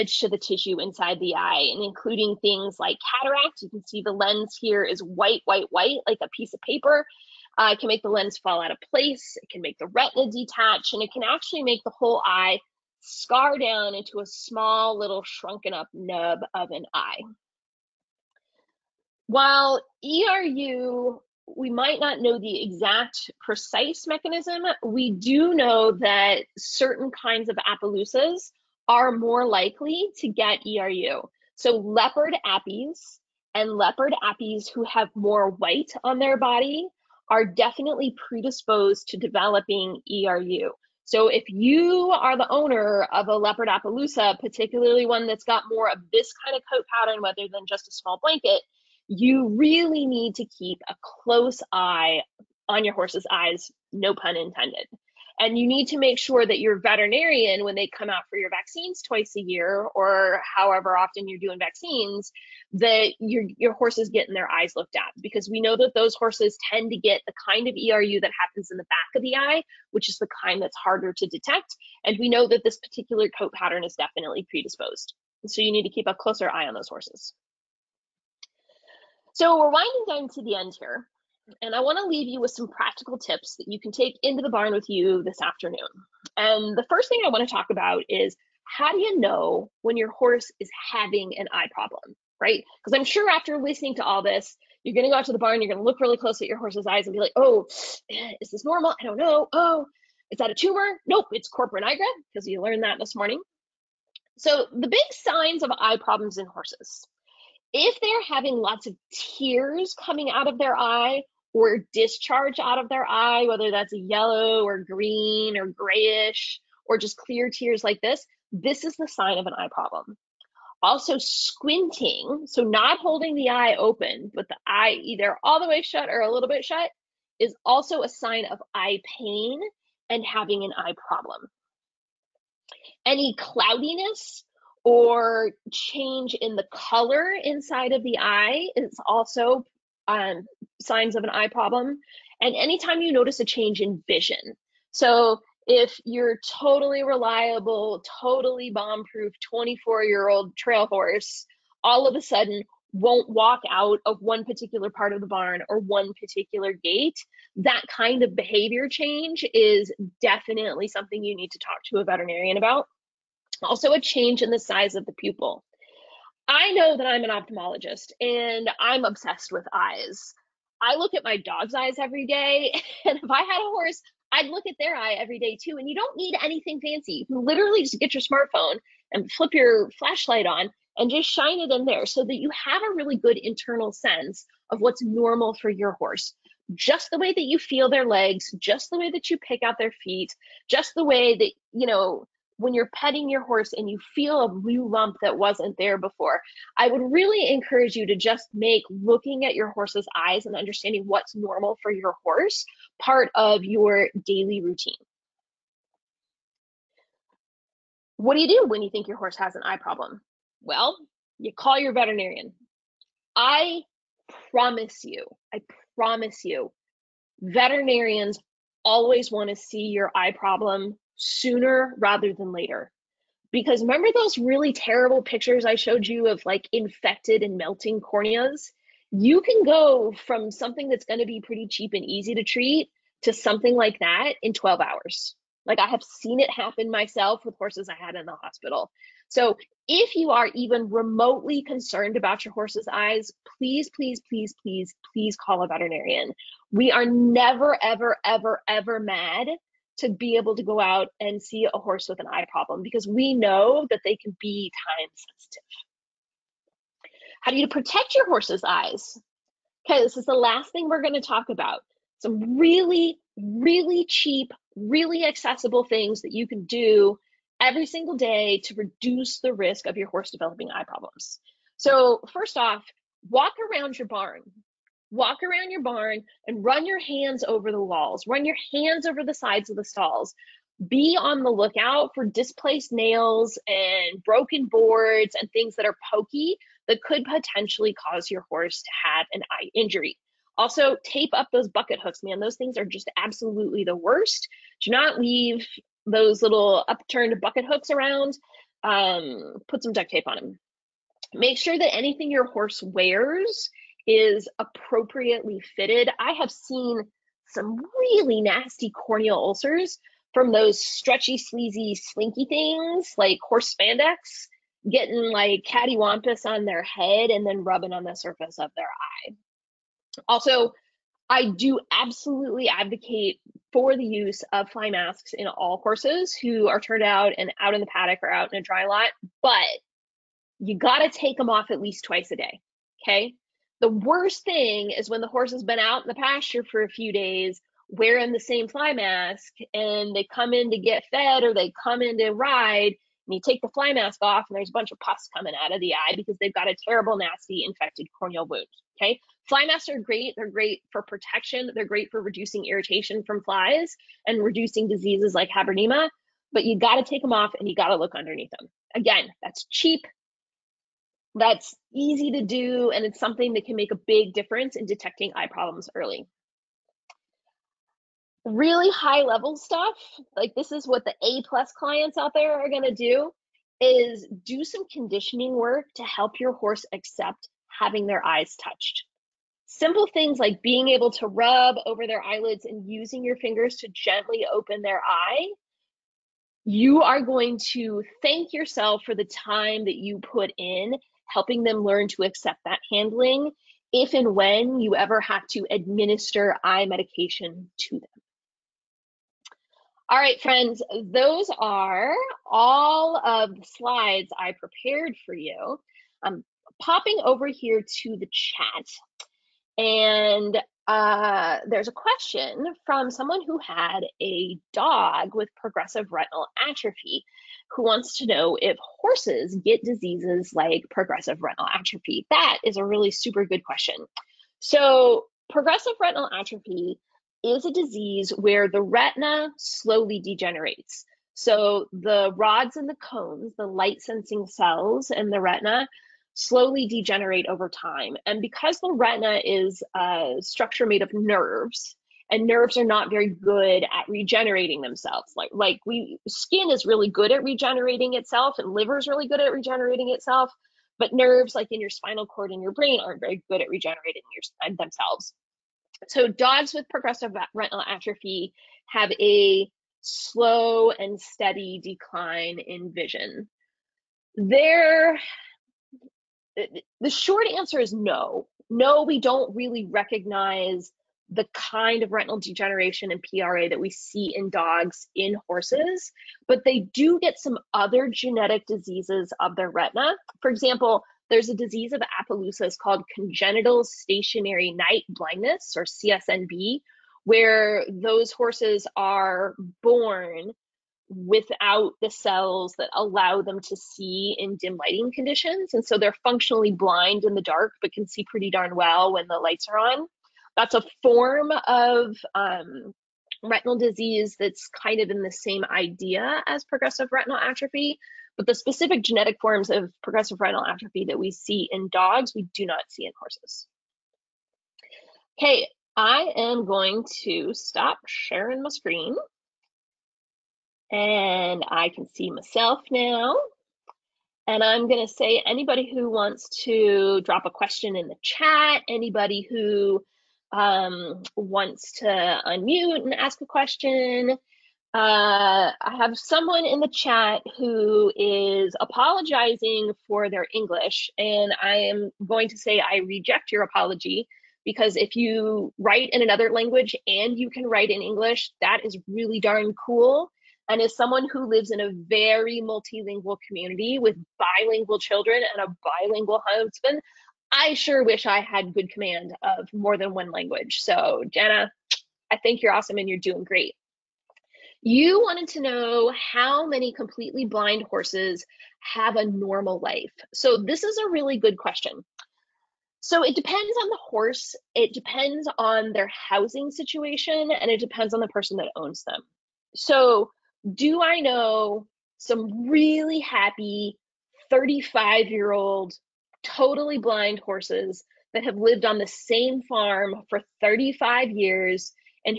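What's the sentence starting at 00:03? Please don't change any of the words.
You can see the lens here is white, white, white, like a piece of paper.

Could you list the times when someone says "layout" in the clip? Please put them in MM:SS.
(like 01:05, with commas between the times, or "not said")
not said.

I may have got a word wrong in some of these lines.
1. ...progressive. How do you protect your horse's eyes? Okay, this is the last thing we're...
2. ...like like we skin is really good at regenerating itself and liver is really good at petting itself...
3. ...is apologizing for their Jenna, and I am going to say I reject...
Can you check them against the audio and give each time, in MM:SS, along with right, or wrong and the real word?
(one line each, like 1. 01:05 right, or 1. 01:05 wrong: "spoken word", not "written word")
1. 04:15 wrong: "sensitive", not "progressive"
2. 07:25 wrong: "regenerating", not "petting"
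3. 08:58 wrong: "English", not "Jenna".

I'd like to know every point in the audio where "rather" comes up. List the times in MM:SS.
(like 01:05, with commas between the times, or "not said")
00:47, 03:41.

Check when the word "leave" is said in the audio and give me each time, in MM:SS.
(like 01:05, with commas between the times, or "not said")
01:22, 04:55.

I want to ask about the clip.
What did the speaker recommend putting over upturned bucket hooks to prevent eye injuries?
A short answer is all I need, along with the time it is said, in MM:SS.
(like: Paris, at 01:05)
Duct tape, at 04:59.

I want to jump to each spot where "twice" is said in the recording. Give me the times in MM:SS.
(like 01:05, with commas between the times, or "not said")
00:59, 05:32.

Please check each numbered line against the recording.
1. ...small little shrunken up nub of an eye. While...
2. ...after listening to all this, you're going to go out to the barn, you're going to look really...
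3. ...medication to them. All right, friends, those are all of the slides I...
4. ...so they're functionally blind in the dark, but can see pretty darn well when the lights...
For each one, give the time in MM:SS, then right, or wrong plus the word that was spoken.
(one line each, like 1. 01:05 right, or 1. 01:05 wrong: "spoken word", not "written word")
1. 00:14 right
2. 01:33 right
3. 06:36 right
4. 08:15 right.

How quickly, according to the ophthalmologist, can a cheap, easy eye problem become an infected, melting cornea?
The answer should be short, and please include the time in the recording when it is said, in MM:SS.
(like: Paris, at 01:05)
12 hours, at 03:54.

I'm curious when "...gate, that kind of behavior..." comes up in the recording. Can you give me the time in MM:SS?
02:36.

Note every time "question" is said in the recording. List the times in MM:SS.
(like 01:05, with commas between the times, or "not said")
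06:51, 07:03, 08:47, 08:53, 09:31.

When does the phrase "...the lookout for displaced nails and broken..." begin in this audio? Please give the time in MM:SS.
04:41.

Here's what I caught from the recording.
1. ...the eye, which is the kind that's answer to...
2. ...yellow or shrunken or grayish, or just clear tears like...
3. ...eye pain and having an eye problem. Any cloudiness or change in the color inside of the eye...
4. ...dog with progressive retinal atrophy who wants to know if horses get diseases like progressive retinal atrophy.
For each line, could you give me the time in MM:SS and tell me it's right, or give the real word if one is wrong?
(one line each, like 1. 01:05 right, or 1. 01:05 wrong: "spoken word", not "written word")
1. 01:09 wrong: "harder", not "answer"
2. 01:53 wrong: "green", not "shrunken"
3. 02:08 right
4. 06:54 right.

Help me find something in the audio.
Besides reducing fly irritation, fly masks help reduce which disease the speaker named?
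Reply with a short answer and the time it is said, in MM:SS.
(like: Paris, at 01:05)
Habronema, at 05:55.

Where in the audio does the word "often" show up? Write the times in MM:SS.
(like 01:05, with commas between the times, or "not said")
01:00.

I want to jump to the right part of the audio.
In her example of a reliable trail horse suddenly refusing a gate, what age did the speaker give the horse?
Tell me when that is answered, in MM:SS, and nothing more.
02:29.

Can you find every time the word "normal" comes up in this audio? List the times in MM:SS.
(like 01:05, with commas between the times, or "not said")
01:38, 03:05, 03:21, 09:29.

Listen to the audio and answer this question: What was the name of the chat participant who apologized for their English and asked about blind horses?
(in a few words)
Jenna.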